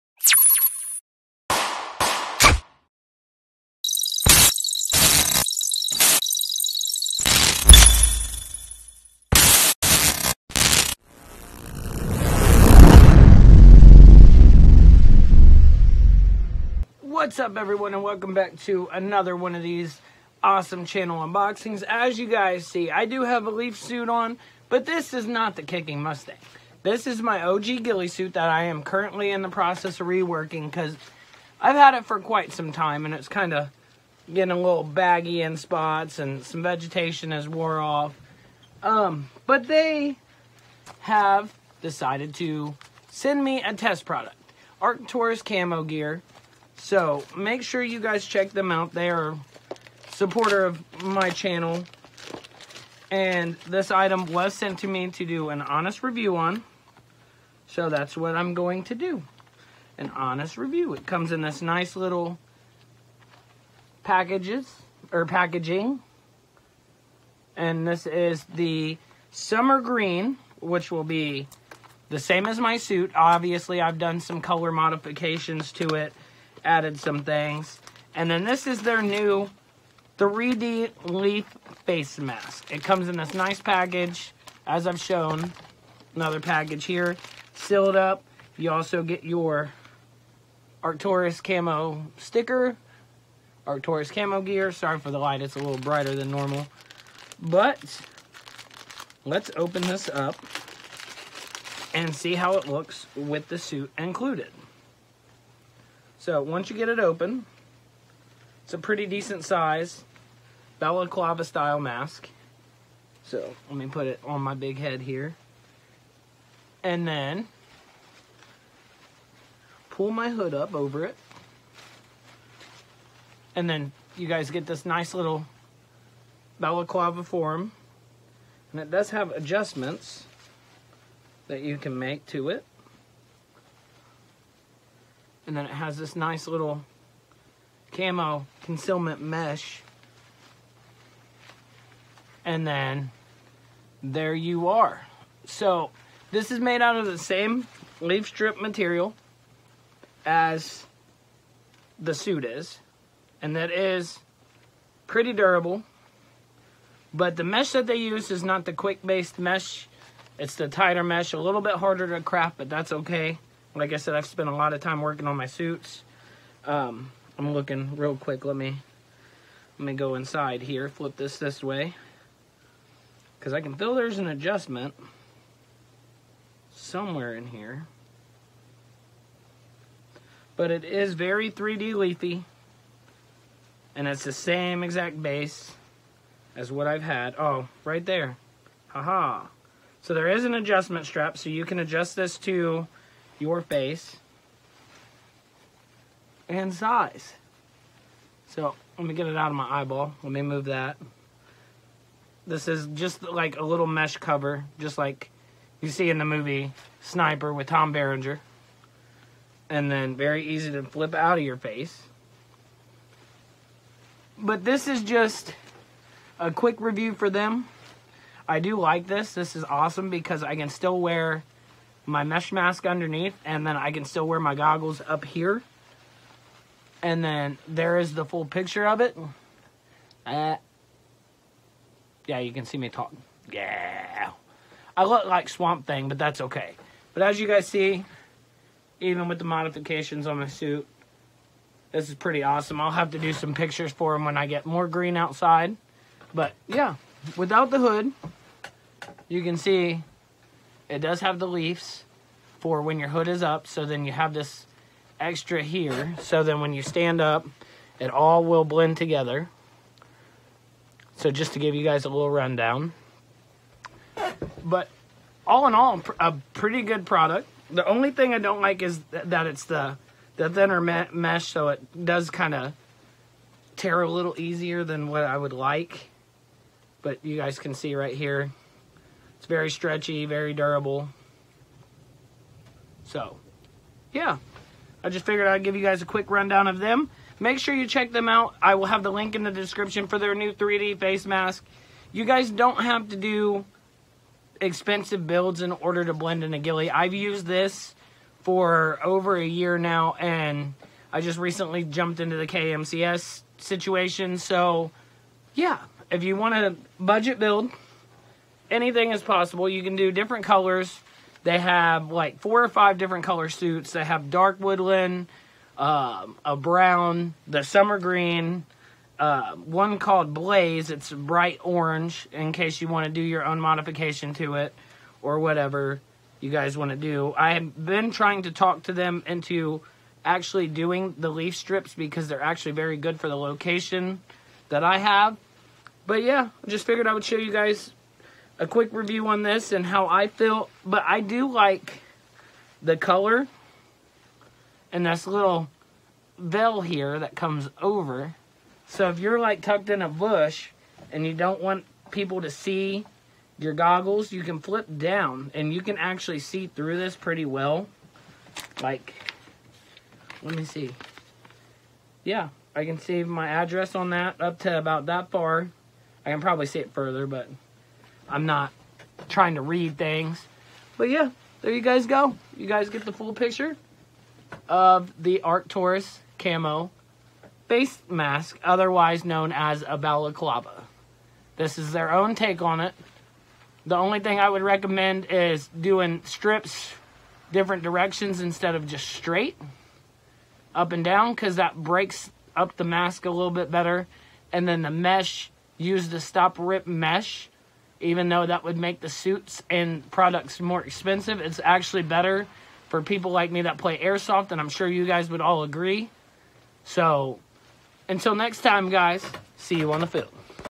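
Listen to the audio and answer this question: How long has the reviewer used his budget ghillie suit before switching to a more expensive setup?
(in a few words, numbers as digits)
over a year.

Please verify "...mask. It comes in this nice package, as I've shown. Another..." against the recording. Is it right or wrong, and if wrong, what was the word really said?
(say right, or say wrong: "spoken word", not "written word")
right.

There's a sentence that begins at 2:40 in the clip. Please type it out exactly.
It's the tighter mesh, a little bit harder to craft, but that's okay.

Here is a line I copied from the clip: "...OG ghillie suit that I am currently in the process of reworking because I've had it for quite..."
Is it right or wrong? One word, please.
right.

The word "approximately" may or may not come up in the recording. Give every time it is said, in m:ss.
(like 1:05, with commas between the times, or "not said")
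not said.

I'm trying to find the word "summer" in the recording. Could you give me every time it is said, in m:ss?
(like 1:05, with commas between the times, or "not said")
1:09, 5:17.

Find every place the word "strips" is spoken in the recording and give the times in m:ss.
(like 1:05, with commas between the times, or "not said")
2:28, 5:31, 6:26.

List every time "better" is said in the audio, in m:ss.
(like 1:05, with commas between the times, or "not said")
6:33, 6:42.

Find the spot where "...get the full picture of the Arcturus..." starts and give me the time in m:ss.
6:12.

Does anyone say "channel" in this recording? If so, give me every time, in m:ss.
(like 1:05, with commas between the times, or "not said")
0:20, 0:51.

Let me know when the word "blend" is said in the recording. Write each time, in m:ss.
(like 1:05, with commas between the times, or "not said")
4:18, 4:56.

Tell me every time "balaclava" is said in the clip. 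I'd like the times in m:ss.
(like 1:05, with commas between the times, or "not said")
1:50, 2:06, 6:19.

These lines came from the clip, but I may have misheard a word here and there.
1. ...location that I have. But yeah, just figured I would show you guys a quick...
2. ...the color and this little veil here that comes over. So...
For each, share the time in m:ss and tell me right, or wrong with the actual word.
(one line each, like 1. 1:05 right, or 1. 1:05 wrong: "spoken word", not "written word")
1. 5:33 right
2. 5:42 right.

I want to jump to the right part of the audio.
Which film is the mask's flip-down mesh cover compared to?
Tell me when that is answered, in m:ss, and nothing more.
3:27.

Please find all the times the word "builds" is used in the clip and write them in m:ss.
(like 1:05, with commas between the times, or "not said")
4:55, 5:07.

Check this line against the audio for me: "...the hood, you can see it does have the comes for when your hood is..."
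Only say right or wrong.
wrong.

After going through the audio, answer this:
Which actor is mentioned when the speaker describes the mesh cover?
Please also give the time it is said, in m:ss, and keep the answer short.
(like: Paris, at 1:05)
Tom Berenger, at 3:27.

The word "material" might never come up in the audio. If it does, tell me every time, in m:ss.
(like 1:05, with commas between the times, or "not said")
2:28.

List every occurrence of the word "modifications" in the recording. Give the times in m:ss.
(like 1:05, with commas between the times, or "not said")
1:14, 3:59, 5:23.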